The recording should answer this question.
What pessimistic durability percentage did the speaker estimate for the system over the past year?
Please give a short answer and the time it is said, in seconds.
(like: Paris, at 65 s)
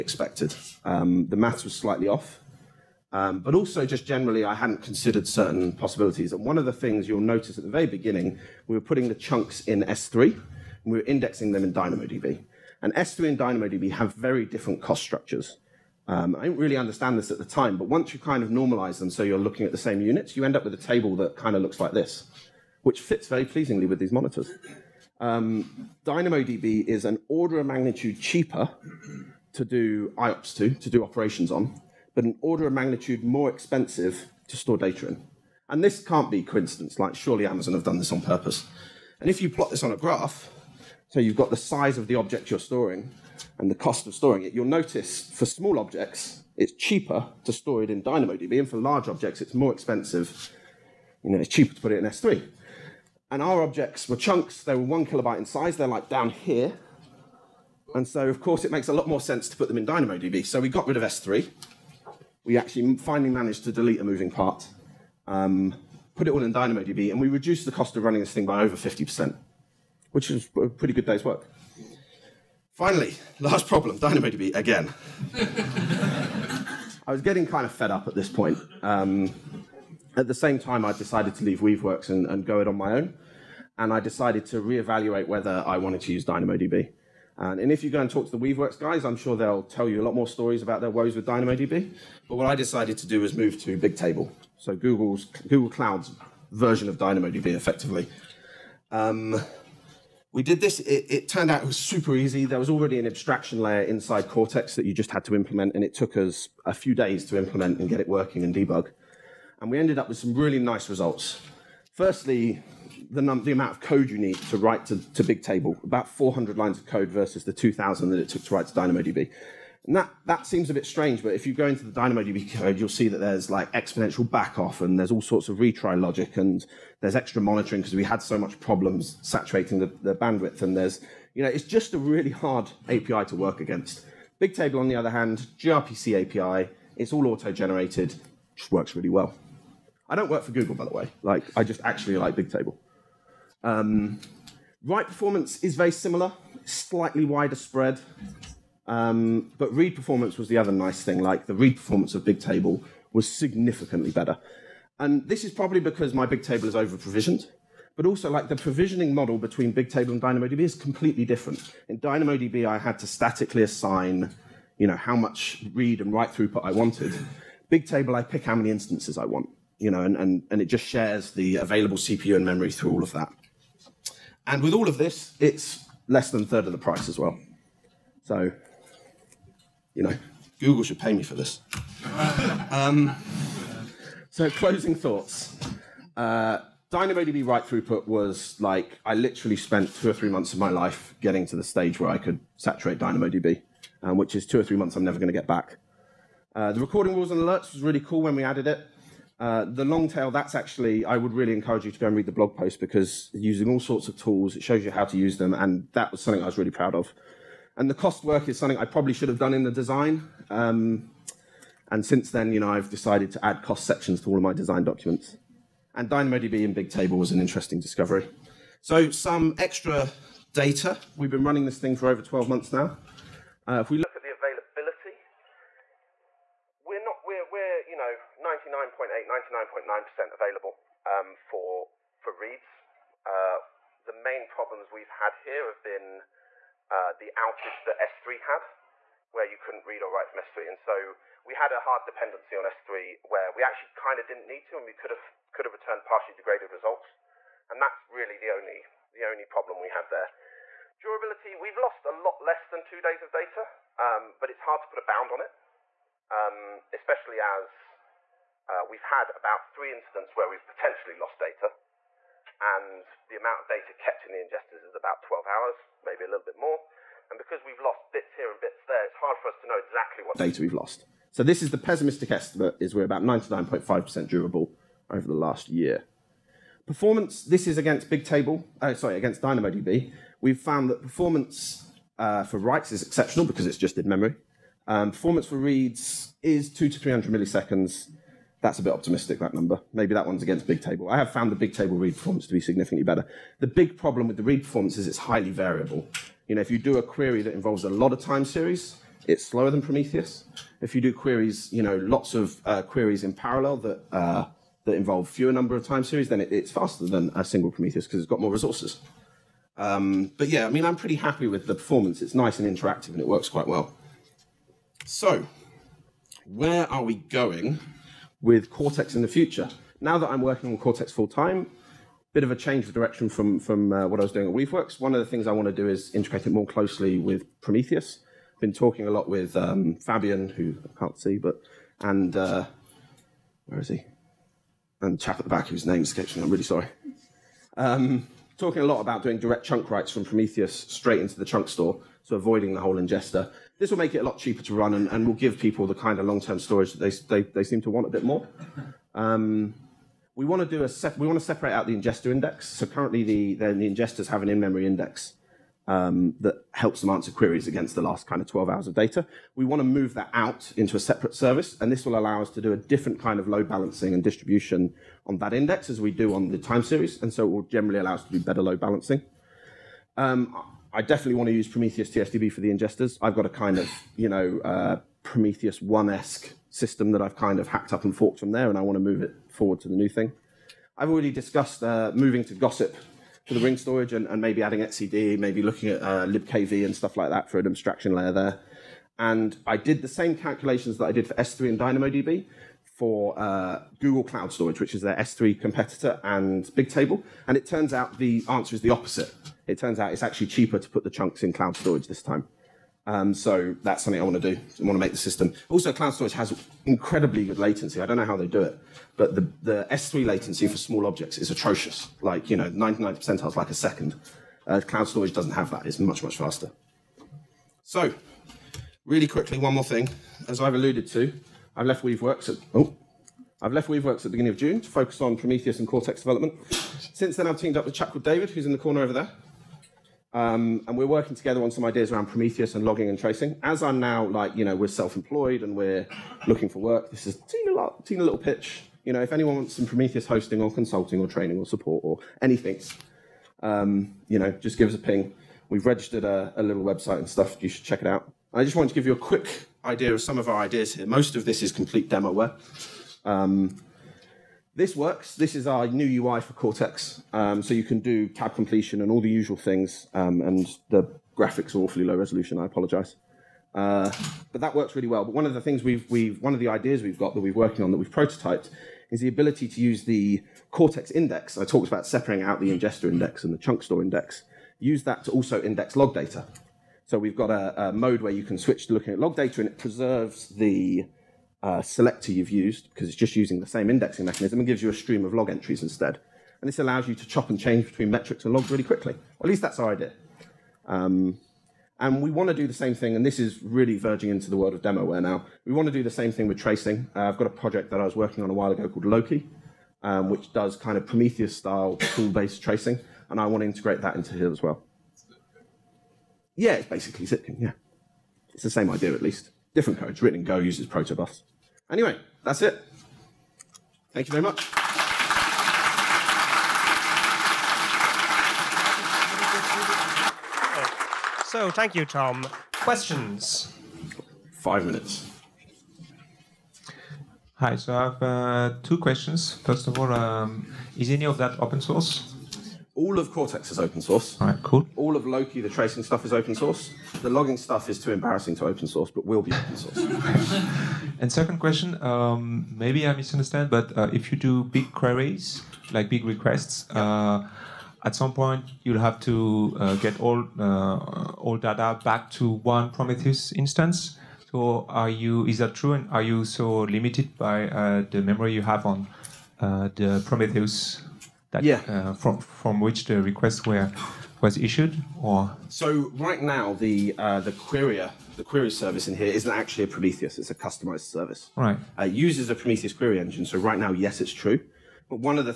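99.5%, at 273 s.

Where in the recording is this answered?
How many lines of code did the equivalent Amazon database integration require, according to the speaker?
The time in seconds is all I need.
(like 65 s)
117 s.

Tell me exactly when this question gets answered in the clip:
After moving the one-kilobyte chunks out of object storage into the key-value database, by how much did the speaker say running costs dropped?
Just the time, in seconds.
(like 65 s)
68 s.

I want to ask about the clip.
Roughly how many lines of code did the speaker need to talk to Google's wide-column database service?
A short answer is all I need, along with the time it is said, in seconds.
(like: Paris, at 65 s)
400, at 115 s.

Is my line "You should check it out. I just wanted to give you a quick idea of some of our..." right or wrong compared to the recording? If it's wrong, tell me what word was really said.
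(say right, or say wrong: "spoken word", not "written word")
right.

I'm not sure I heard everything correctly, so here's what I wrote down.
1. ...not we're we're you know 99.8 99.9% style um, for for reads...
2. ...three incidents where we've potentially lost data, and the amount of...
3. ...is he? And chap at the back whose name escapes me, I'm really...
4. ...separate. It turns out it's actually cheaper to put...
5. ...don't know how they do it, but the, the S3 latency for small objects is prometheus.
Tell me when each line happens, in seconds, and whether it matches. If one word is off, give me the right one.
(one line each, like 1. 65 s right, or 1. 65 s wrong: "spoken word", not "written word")
1. 226 s wrong: "available", not "style"
2. 259 s right
3. 333 s right
4. 398 s wrong: "opposite", not "separate"
5. 408 s wrong: "atrocious", not "prometheus".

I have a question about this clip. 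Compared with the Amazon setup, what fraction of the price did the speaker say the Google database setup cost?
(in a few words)
less than a third.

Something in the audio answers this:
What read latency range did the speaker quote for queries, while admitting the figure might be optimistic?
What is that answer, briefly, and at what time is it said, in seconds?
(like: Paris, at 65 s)
200 to 300 milliseconds, at 286 s.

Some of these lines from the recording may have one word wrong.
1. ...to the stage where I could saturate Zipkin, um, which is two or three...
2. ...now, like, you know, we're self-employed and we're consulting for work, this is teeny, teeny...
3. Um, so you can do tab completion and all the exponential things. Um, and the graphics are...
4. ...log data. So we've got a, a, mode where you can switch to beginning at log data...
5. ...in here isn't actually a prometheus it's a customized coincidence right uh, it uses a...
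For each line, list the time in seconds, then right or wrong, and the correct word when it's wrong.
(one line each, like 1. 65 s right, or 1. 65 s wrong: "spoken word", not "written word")
1. 191 s wrong: "DynamoDB", not "Zipkin"
2. 433 s wrong: "looking", not "consulting"
3. 457 s wrong: "usual", not "exponential"
4. 475 s wrong: "looking", not "beginning"
5. 569 s wrong: "service", not "coincidence".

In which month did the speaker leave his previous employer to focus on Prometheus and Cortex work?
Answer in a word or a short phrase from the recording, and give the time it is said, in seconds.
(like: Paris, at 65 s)
June, at 424 s.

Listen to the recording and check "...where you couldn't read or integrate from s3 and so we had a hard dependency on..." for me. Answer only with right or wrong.
wrong.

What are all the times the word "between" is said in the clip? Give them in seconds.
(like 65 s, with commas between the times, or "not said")
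159 s, 487 s.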